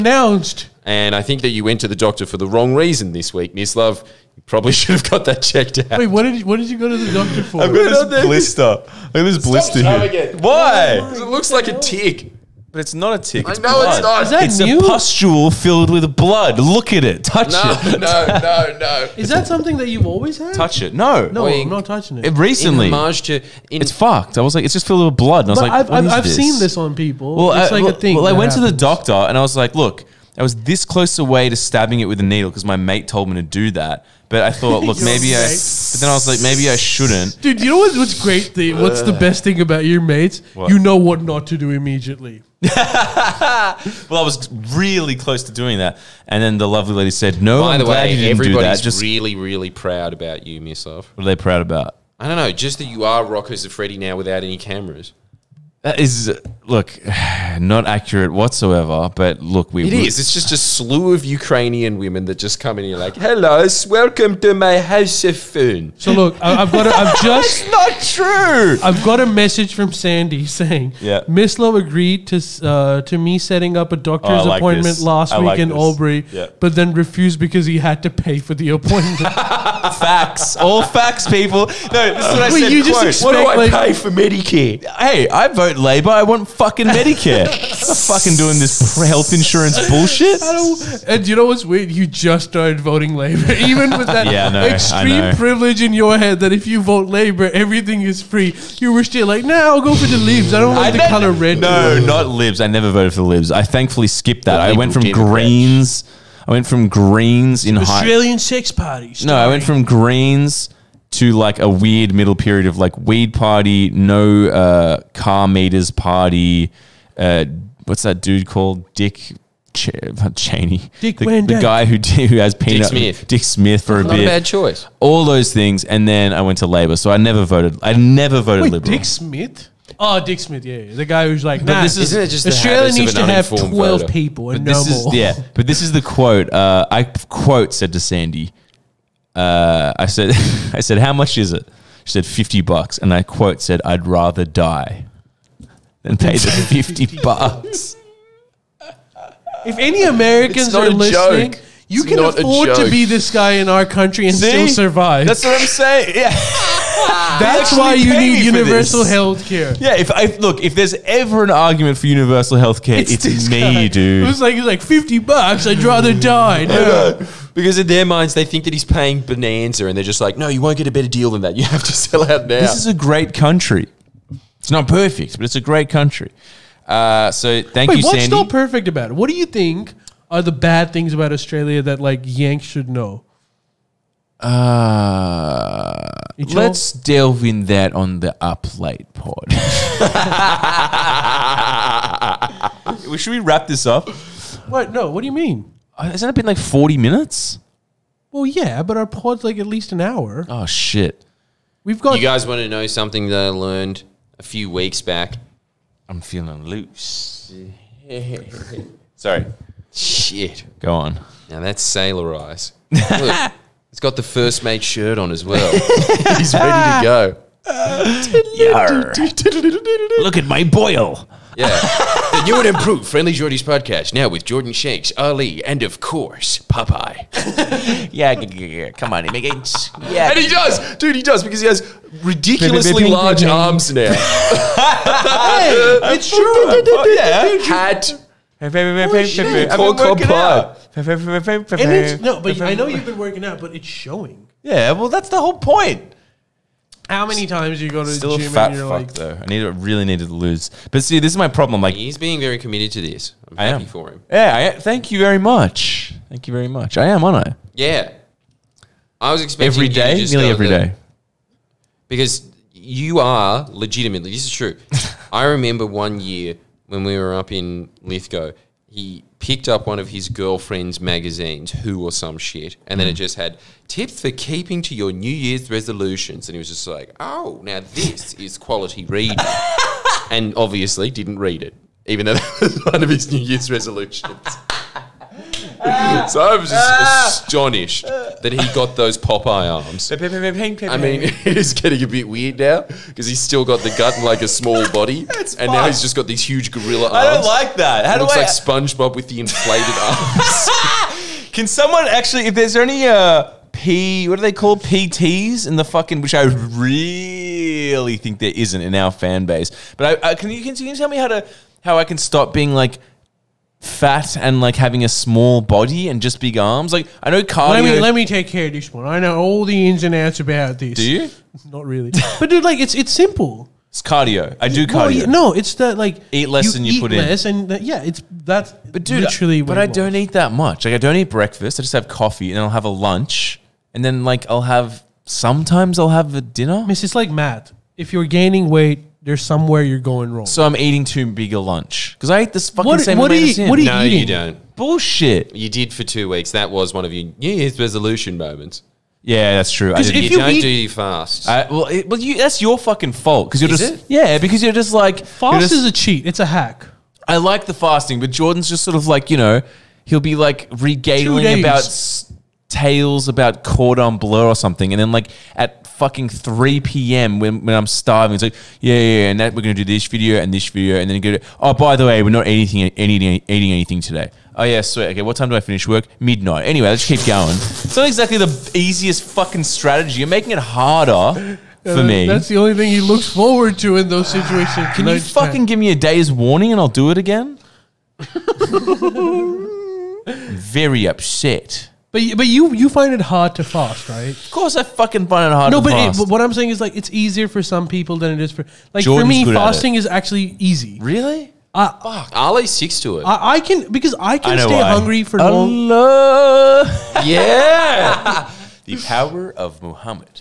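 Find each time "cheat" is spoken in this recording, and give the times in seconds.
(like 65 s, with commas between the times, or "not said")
355 s.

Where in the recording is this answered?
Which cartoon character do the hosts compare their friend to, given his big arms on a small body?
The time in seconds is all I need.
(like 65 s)
298 s.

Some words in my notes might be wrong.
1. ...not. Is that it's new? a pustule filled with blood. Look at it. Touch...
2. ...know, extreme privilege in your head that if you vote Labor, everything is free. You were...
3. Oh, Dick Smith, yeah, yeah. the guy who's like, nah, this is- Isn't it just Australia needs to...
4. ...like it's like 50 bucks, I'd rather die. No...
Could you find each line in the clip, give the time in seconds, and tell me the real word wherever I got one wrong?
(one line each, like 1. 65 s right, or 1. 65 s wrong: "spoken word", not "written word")
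1. 14 s right
2. 94 s right
3. 129 s right
4. 164 s right.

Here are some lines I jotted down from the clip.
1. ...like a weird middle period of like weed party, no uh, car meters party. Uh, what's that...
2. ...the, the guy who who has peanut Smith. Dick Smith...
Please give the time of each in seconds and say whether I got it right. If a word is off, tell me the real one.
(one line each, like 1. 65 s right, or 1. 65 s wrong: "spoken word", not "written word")
1. 111 s right
2. 121 s right.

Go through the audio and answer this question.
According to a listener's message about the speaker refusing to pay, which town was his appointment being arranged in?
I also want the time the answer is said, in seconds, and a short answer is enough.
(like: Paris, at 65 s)
Albury, at 75 s.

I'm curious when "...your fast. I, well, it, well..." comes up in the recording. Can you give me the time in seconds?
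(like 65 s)
350 s.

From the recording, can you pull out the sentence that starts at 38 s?
The, what's the best thing about your mates?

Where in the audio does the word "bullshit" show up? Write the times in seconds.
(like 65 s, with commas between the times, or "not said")
89 s, 344 s.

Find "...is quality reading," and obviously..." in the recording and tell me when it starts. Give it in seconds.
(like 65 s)
278 s.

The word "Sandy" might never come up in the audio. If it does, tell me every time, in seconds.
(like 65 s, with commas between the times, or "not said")
69 s, 137 s, 178 s.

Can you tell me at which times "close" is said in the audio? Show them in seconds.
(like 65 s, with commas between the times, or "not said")
30 s, 45 s.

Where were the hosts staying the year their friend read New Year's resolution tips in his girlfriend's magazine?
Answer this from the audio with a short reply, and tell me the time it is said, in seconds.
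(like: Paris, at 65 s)
Lithgow, at 268 s.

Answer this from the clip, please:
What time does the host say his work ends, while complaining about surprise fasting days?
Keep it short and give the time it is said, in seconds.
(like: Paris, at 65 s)
Midnight, at 376 s.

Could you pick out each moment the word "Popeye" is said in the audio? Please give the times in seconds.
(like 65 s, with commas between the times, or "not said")
226 s, 289 s.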